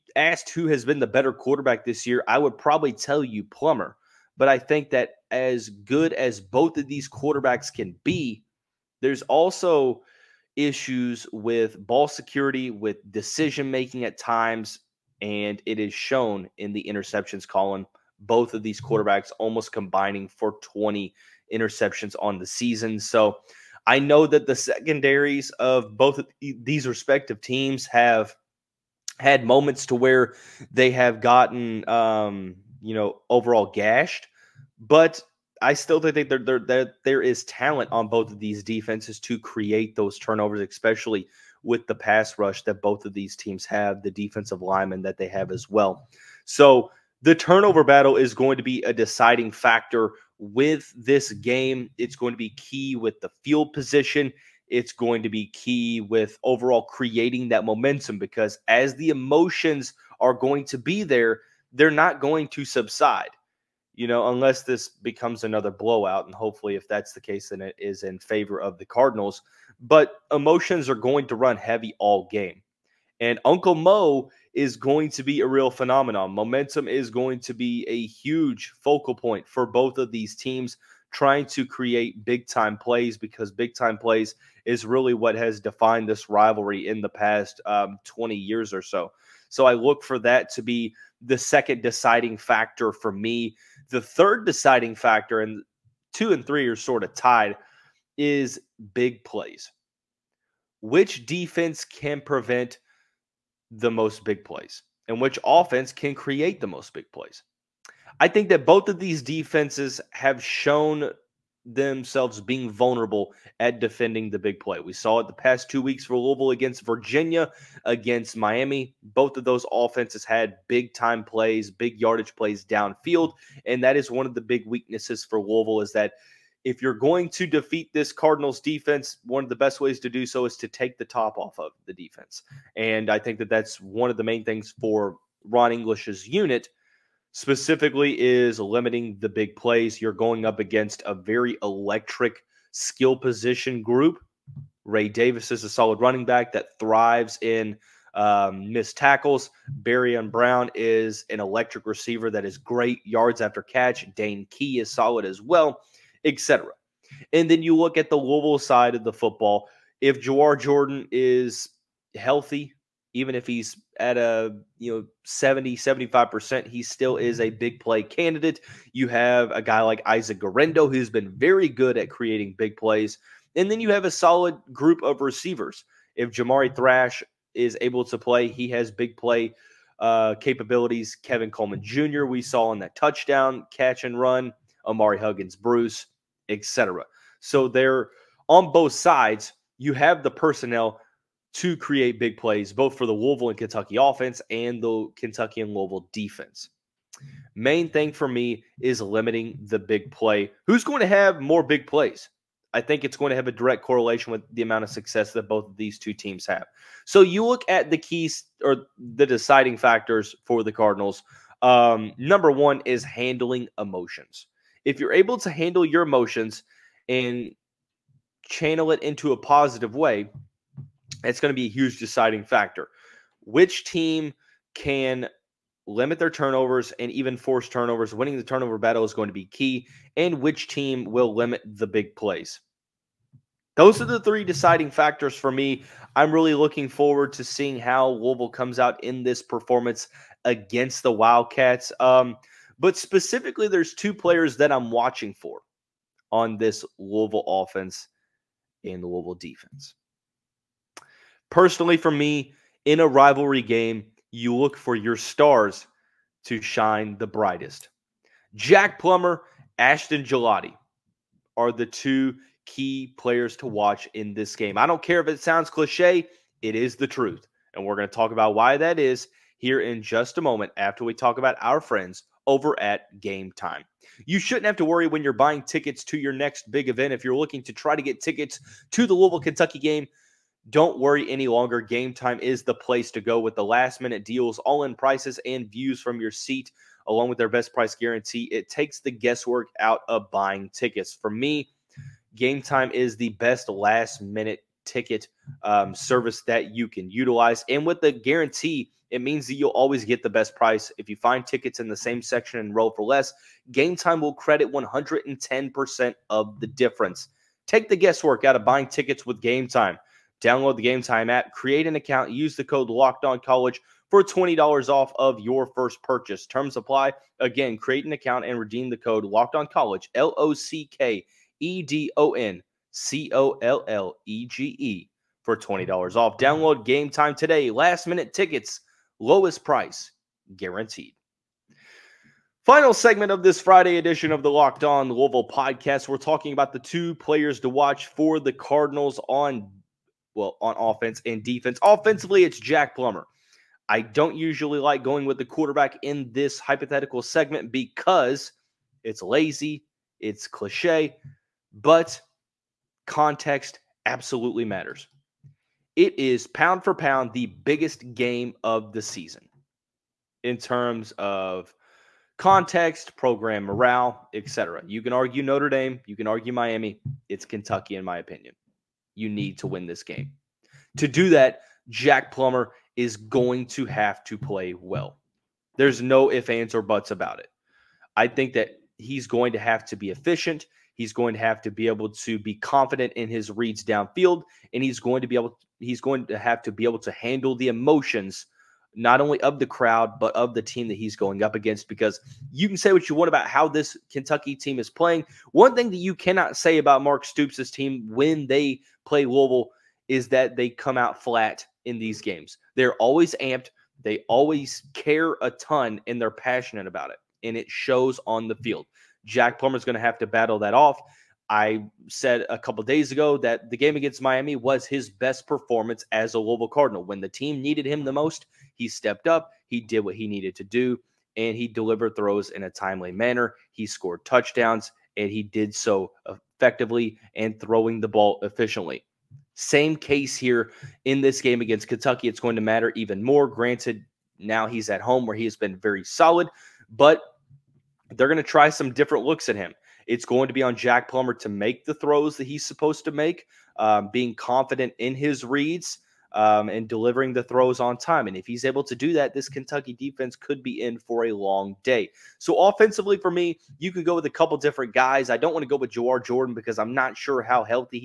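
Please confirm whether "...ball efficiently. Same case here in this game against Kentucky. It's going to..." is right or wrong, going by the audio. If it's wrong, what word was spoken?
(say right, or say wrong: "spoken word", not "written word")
right.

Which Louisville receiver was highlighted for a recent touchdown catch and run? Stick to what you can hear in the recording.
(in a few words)
Kevin Coleman Jr.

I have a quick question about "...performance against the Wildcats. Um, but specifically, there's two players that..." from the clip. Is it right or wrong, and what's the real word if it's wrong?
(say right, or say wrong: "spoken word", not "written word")
right.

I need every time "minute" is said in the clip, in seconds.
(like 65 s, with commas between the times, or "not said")
283 s, 294 s, 328 s.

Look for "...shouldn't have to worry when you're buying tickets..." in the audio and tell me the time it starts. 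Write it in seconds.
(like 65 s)
274 s.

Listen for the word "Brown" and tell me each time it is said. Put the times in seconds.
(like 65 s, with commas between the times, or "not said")
150 s.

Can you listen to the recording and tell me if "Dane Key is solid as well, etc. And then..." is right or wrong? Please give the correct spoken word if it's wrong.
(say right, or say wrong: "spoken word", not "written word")
right.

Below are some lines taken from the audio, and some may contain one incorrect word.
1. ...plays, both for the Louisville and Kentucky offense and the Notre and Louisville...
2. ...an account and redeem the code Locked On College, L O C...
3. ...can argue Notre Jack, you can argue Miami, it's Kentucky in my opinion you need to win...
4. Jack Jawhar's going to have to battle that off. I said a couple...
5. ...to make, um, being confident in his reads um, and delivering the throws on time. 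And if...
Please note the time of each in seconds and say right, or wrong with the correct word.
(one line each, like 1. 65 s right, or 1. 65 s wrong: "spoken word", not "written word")
1. 192 s wrong: "Kentucky", not "Notre"
2. 318 s right
3. 365 s wrong: "Dame", not "Jack"
4. 409 s wrong: "Plummer", not "Jawhar"
5. 443 s right.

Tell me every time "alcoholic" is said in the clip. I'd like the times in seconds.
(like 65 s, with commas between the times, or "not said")
not said.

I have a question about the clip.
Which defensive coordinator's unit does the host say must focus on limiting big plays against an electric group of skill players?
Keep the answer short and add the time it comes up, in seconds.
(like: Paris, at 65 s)
Ron English, at 135 s.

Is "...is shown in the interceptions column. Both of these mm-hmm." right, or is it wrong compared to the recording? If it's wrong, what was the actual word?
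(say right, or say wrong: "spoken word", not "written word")
right.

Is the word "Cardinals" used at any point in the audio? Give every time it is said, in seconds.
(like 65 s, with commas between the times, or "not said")
68 s, 128 s, 210 s, 338 s, 416 s.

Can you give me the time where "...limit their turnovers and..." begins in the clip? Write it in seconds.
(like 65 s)
225 s.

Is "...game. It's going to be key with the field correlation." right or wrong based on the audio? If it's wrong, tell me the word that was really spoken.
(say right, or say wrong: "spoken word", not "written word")
wrong: "position", not "correlation".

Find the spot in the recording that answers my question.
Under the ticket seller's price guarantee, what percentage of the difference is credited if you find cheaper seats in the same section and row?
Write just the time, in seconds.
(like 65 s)
304 s.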